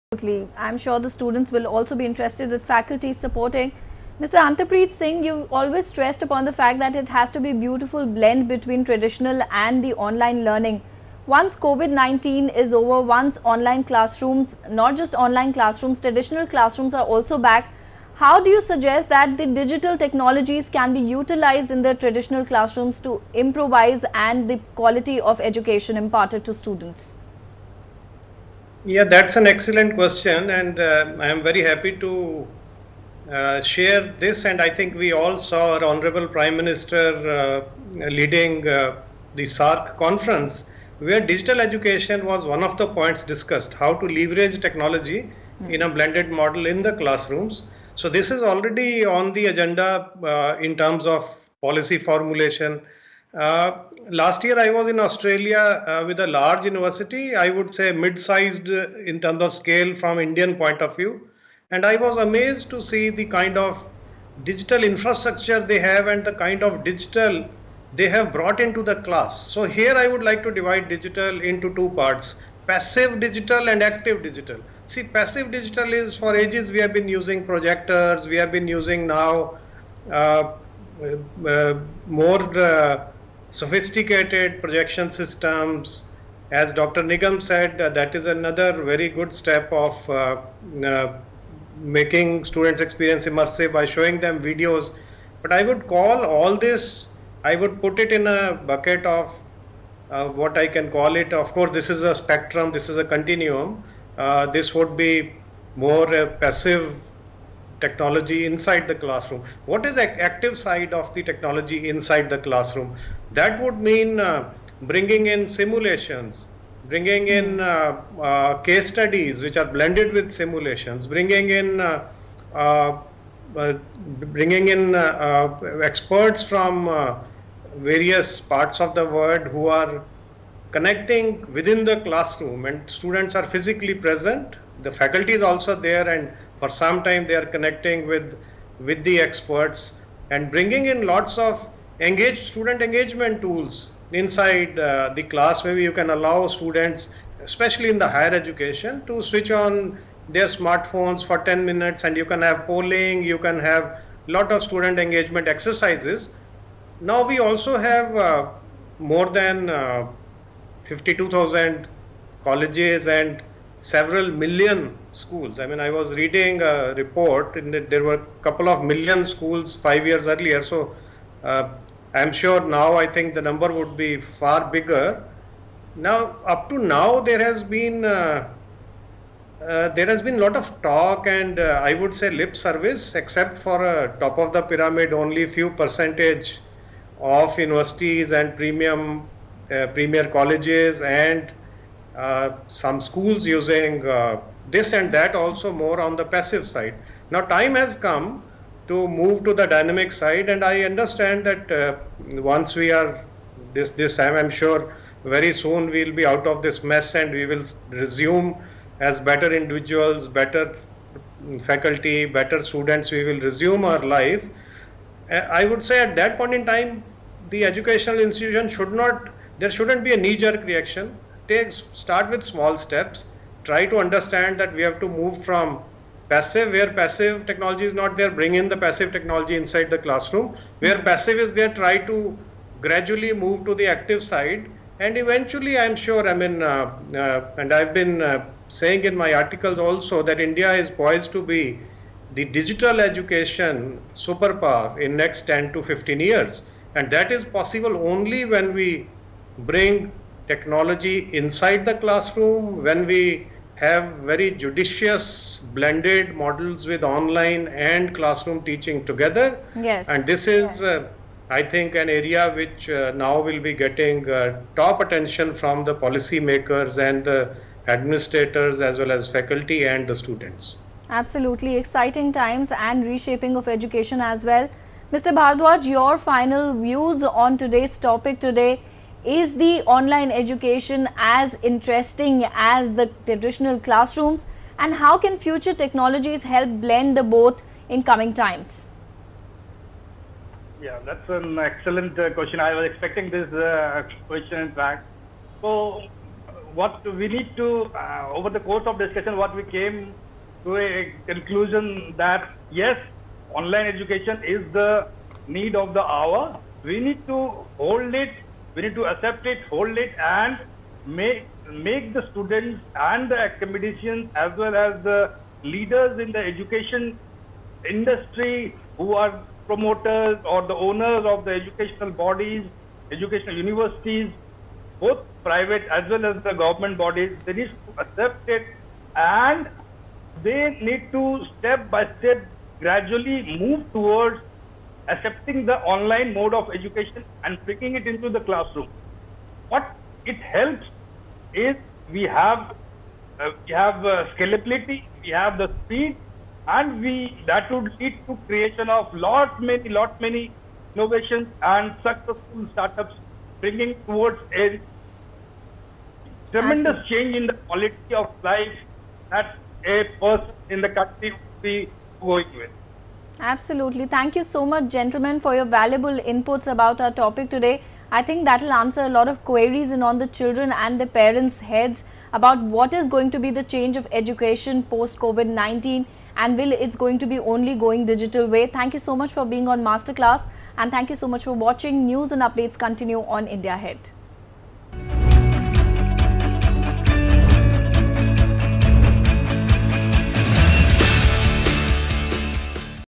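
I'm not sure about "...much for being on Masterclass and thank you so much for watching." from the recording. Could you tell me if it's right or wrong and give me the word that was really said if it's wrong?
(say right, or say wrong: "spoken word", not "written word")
right.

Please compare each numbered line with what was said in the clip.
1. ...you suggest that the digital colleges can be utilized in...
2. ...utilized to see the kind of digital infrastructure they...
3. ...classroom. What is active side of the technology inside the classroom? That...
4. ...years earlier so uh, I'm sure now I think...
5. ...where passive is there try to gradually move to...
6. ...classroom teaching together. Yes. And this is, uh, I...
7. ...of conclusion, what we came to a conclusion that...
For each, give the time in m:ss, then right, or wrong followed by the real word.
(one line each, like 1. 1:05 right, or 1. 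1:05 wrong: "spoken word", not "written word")
1. 0:18 wrong: "technologies", not "colleges"
2. 1:02 wrong: "amazed", not "utilized"
3. 1:48 right
4. 2:50 right
5. 3:50 right
6. 4:18 right
7. 4:58 wrong: "discussion", not "conclusion".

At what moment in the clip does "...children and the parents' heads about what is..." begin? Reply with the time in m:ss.
6:10.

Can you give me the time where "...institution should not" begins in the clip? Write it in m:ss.
3:38.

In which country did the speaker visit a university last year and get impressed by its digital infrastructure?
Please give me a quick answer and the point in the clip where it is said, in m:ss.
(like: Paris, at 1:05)
Australia, at 0:54.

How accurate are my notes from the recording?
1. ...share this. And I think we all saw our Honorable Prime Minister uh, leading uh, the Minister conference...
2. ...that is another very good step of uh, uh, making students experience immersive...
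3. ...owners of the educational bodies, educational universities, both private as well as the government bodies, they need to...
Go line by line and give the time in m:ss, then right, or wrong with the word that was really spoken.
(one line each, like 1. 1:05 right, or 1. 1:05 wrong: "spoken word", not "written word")
1. 0:33 wrong: "SAARC", not "Minister"
2. 1:27 right
3. 5:20 right.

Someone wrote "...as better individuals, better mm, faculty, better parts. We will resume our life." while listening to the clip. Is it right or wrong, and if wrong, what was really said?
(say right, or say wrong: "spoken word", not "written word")
wrong: "students", not "parts".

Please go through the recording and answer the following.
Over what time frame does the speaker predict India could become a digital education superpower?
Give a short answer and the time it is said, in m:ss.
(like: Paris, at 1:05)
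10 to 15 years, at 4:05.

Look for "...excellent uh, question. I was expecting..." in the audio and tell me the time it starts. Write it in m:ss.
4:51.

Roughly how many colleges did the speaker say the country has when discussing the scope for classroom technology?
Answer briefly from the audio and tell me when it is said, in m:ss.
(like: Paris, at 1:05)
52,000, at 2:40.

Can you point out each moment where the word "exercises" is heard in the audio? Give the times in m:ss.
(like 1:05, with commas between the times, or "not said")
2:35.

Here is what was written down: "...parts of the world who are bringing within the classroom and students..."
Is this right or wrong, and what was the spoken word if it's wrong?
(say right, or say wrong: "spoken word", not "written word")
wrong: "connecting", not "bringing".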